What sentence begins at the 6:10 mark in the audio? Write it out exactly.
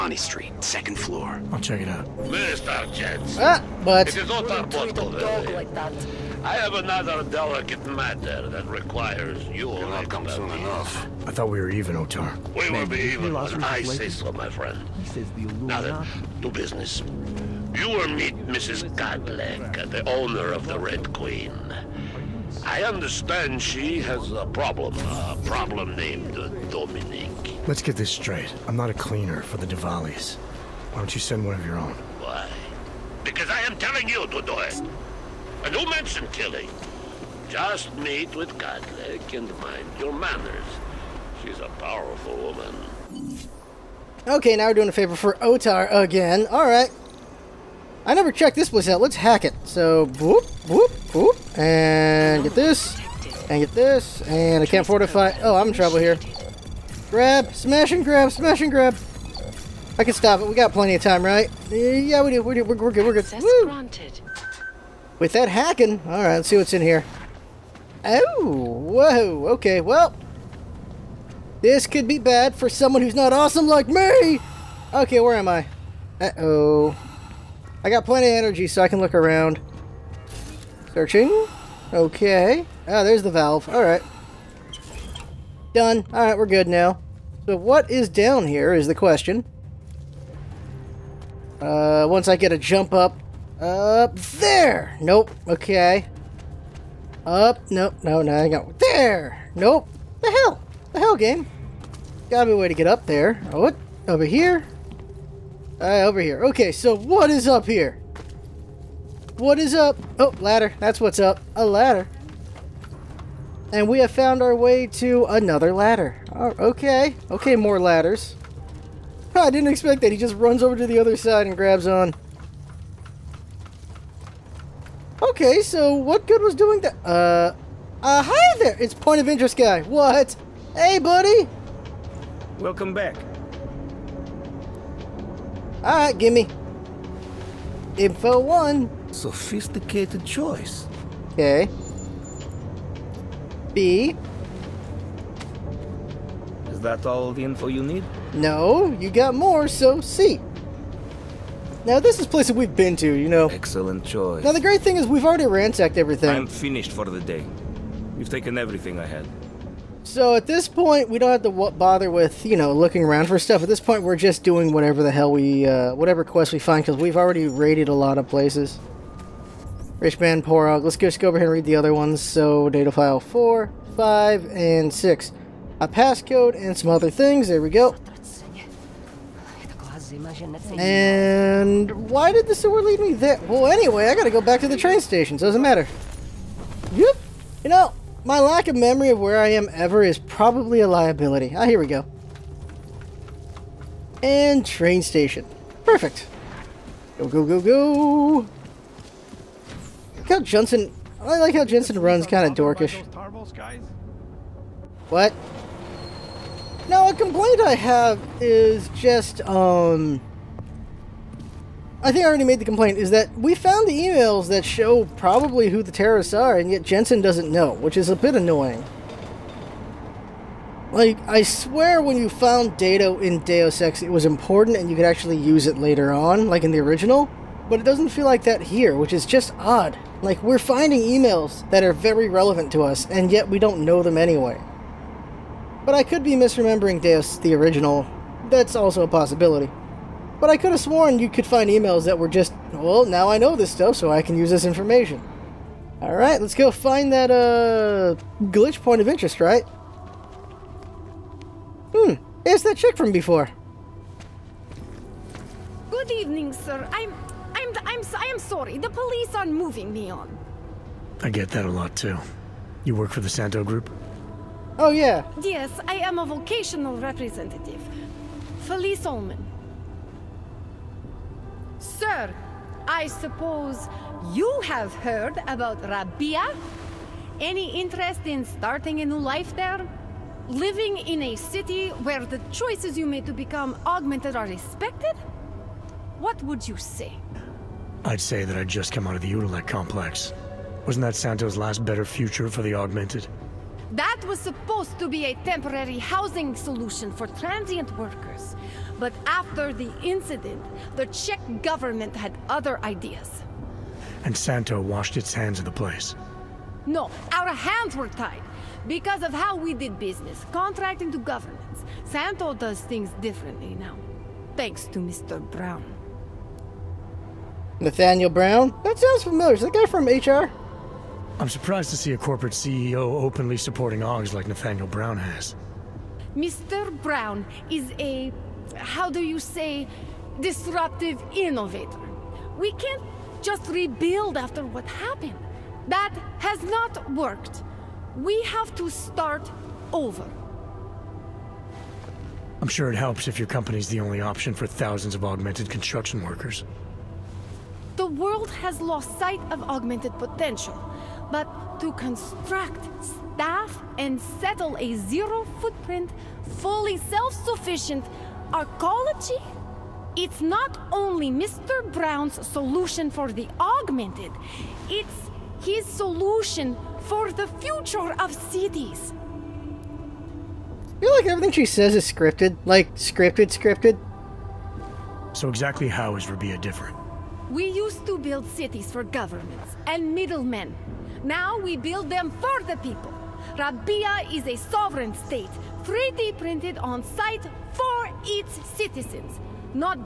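I feel like everything she says is scripted.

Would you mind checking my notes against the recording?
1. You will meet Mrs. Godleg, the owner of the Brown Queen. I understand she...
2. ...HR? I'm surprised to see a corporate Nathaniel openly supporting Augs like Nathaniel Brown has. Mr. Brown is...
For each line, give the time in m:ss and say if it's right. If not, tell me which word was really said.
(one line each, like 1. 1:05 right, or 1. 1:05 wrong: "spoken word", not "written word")
1. 0:17 wrong: "Red", not "Brown"
2. 5:20 wrong: "CEO", not "Nathaniel".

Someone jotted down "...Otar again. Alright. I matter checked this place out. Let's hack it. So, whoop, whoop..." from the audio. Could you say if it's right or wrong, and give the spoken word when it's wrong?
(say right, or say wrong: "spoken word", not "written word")
wrong: "never", not "matter".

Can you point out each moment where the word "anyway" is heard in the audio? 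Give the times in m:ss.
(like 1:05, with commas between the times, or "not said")
3:03, 3:54.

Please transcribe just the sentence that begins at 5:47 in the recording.
The world has lost sight of augmented potential but to construct, staff, and settle a zero-footprint, fully self-sufficient arcology?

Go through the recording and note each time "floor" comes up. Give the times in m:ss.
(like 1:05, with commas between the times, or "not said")
0:00.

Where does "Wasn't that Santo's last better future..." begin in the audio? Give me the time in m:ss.
4:50.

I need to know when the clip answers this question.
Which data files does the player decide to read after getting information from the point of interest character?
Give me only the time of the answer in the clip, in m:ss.
2:53.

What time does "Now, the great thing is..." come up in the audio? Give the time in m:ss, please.
2:34.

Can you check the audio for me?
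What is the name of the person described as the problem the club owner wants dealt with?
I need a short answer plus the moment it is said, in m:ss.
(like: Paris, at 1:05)
Dominic, at 0:26.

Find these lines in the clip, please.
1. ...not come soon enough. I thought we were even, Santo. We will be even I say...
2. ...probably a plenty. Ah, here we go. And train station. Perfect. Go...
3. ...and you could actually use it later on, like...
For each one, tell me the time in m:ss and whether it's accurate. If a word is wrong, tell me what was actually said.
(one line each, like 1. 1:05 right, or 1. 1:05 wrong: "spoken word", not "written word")
1. 0:09 wrong: "Otar", not "Santo"
2. 3:10 wrong: "liability", not "plenty"
3. 3:44 right.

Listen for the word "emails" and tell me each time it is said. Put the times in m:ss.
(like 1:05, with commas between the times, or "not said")
3:33, 3:51, 4:01.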